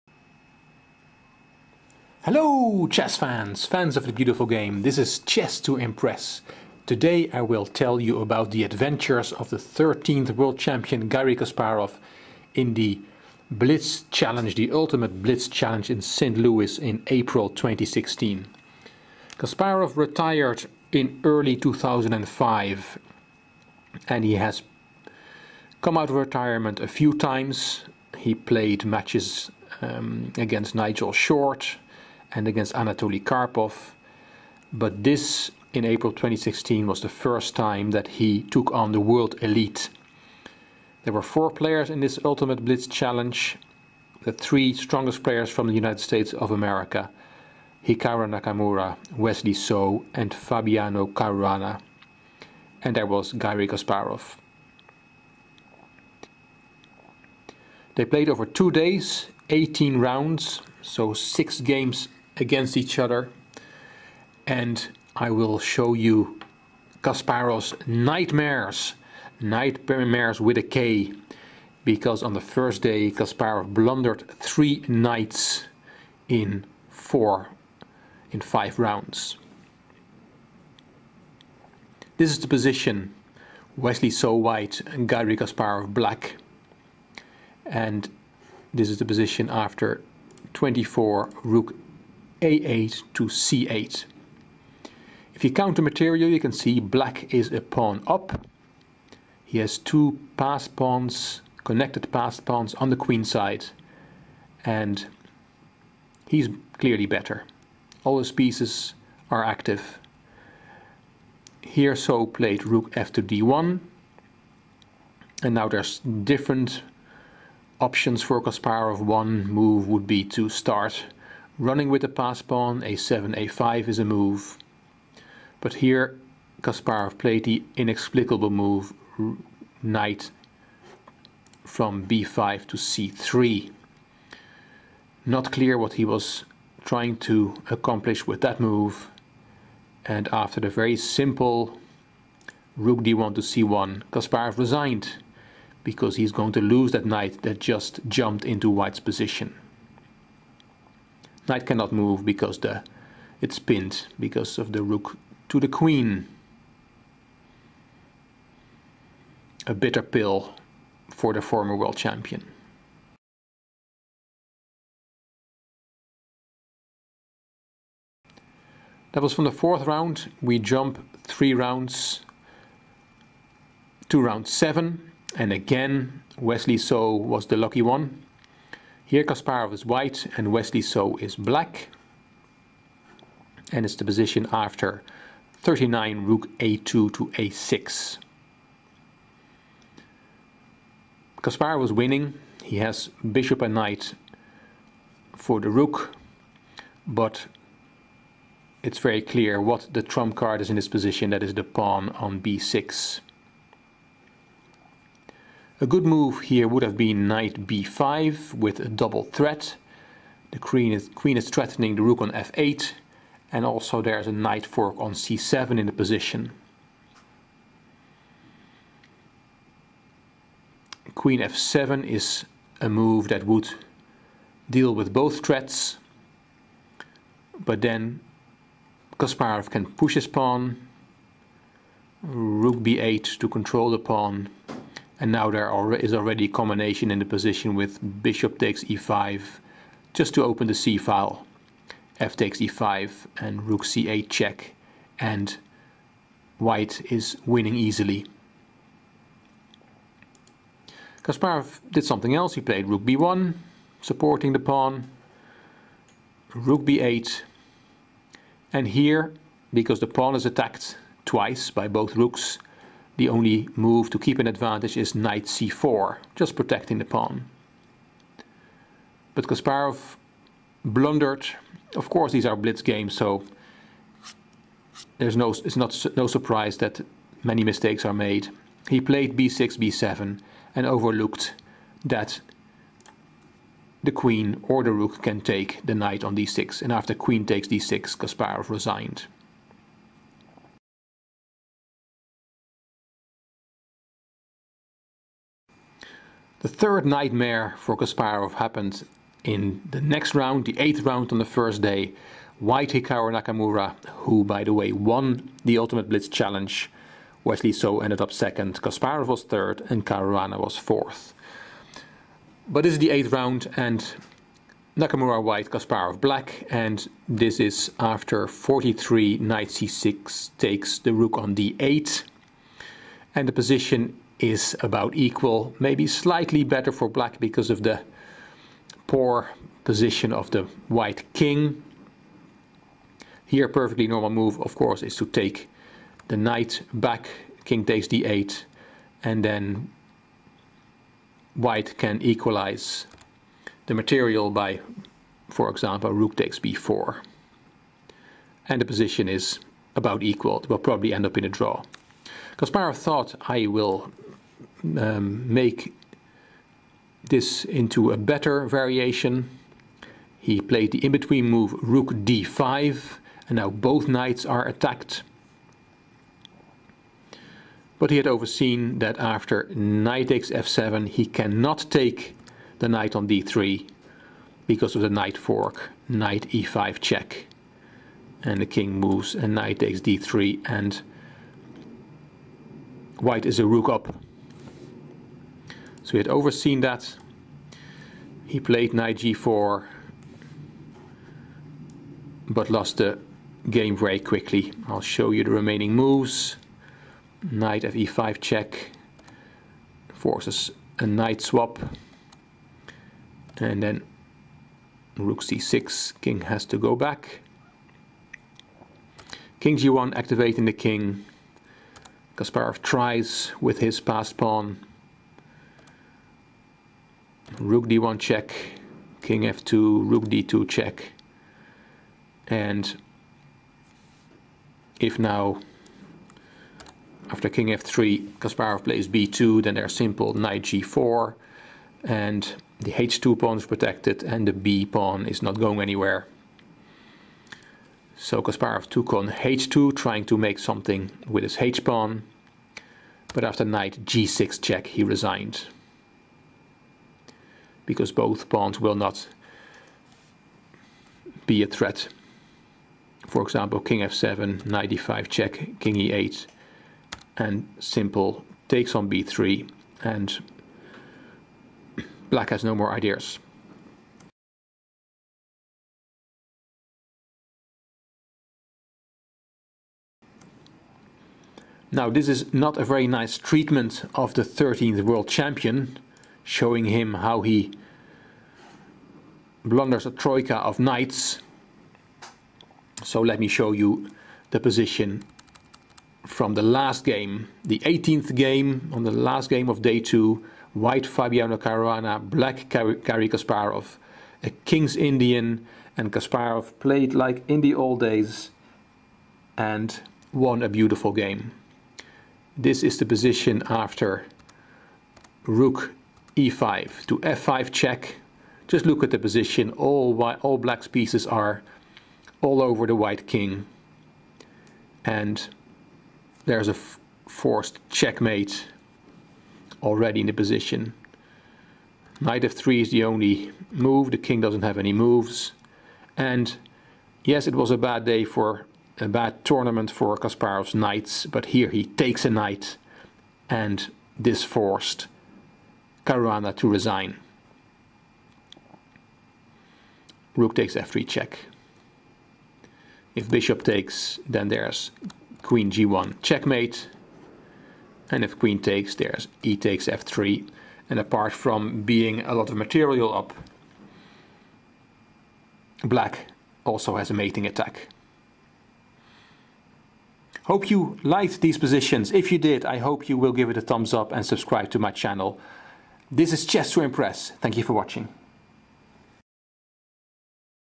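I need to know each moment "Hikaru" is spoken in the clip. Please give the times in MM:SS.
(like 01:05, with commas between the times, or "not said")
00:47, 05:02.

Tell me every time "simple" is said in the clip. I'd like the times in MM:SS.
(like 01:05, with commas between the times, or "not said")
02:20, 07:09, 07:37.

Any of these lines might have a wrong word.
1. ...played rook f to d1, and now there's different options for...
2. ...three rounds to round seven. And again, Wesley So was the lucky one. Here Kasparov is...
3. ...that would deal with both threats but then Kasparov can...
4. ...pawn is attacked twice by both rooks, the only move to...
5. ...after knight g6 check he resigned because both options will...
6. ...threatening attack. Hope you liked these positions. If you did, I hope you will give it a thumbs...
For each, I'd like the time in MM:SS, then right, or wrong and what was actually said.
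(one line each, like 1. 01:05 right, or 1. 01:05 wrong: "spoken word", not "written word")
1. 01:52 right
2. 02:51 right
3. 03:43 right
4. 04:20 right
5. 07:23 wrong: "pawns", not "options"
6. 09:17 wrong: "mating", not "threatening".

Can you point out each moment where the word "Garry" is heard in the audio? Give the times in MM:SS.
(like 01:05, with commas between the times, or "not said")
00:11, 08:12.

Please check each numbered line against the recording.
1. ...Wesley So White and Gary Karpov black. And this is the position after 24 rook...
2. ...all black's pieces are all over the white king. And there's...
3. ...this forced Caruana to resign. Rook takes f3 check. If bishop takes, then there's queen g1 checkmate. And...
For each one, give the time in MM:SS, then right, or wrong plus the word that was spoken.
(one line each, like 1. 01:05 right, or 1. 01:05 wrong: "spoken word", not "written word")
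1. 01:23 wrong: "Kasparov", not "Karpov"
2. 08:30 right
3. 08:54 right.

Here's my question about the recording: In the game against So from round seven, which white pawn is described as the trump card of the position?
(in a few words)
the pawn on b6.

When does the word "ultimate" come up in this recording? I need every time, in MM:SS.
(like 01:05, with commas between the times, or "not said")
00:14, 00:42, 05:05.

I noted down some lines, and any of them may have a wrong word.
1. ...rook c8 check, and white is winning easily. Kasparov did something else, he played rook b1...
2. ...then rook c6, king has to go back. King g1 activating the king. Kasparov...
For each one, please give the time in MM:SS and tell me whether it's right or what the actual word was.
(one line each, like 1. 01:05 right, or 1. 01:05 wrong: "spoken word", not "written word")
1. 04:03 right
2. 06:43 right.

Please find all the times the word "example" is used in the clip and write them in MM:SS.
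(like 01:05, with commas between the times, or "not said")
05:45, 07:33.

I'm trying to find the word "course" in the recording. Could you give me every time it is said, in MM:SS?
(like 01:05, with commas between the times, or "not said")
04:32, 05:34.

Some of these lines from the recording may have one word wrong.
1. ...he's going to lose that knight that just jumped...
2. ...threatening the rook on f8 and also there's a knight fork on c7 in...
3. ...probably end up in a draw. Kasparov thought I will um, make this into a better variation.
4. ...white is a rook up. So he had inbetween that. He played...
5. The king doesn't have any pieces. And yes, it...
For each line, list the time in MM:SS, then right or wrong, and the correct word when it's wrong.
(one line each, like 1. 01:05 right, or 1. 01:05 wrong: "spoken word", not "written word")
1. 02:26 right
2. 03:31 right
3. 05:50 right
4. 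06:23 wrong: "overseen", not "inbetween"
5. 08:44 wrong: "moves", not "pieces".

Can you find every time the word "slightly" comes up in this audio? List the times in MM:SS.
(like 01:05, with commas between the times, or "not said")
05:26.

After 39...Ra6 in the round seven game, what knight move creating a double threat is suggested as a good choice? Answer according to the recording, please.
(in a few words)
Knight b5.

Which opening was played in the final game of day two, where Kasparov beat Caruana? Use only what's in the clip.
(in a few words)
King's Indian.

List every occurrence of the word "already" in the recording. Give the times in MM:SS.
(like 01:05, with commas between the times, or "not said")
03:56, 08:39.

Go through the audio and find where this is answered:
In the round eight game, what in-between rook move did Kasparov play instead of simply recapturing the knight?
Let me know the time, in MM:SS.
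06:01.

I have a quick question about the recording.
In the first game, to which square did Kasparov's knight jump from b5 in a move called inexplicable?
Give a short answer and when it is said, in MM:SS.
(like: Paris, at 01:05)
c3, at 02:12.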